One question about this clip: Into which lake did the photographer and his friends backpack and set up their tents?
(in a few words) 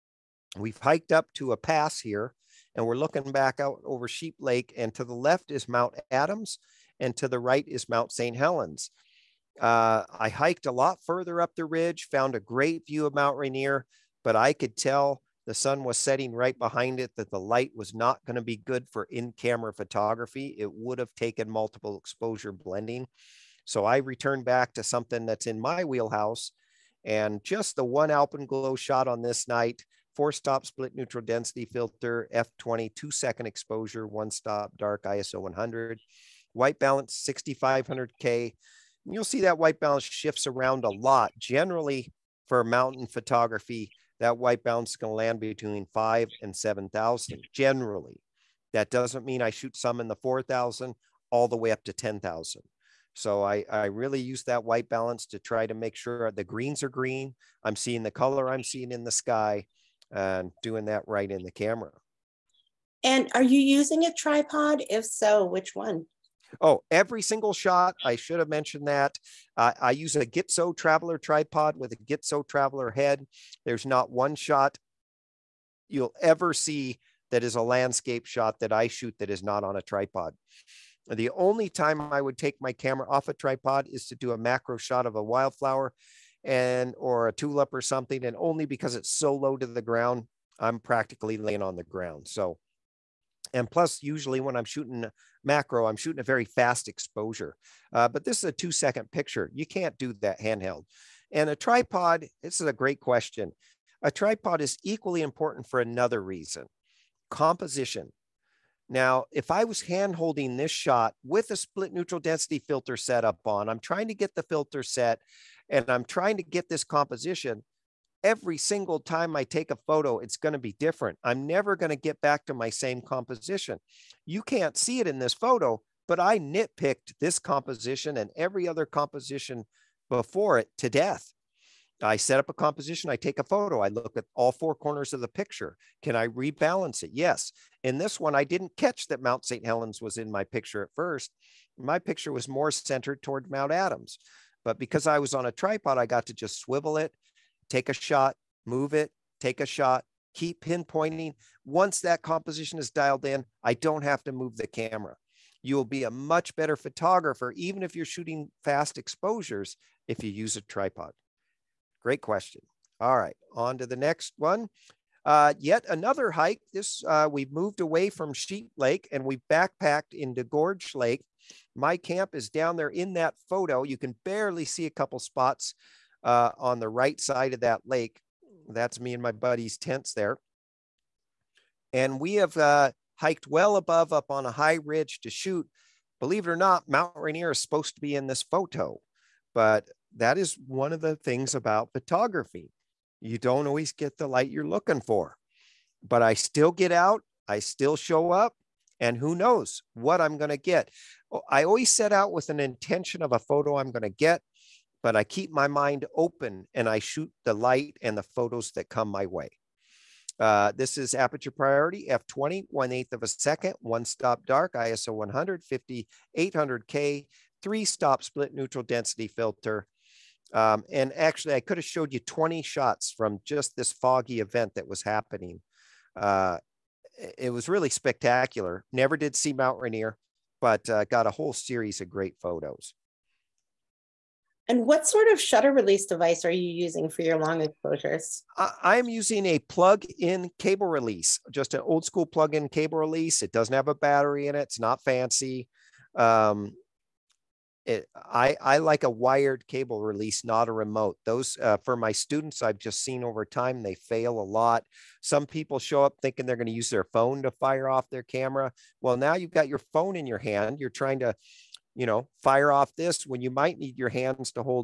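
Gorge Lake.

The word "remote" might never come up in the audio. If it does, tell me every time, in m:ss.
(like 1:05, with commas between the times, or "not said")
4:10.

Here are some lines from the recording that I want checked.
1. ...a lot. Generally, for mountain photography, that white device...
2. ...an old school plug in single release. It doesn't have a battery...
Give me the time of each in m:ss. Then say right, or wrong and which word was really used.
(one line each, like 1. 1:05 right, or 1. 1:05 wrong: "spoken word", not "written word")
1. 0:40 wrong: "balance", not "device"
2. 4:01 wrong: "cable", not "single".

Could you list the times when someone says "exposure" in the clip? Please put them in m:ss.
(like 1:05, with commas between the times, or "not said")
0:21, 0:33, 1:36, 2:38, 3:57.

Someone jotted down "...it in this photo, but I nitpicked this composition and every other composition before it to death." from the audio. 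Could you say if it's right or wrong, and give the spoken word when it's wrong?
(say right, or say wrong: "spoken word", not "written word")
right.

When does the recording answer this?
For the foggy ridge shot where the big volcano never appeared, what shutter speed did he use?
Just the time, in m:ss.
3:32.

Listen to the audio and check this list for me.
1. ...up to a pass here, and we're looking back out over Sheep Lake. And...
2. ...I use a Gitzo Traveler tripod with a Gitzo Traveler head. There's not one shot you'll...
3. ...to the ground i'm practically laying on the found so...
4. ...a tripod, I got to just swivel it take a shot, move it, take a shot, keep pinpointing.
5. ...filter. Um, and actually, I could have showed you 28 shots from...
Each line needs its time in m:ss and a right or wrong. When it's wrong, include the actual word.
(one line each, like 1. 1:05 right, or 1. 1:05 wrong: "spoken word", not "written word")
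1. 0:01 right
2. 1:09 right
3. 1:29 wrong: "ground", not "found"
4. 2:25 right
5. 3:39 wrong: "20", not "28".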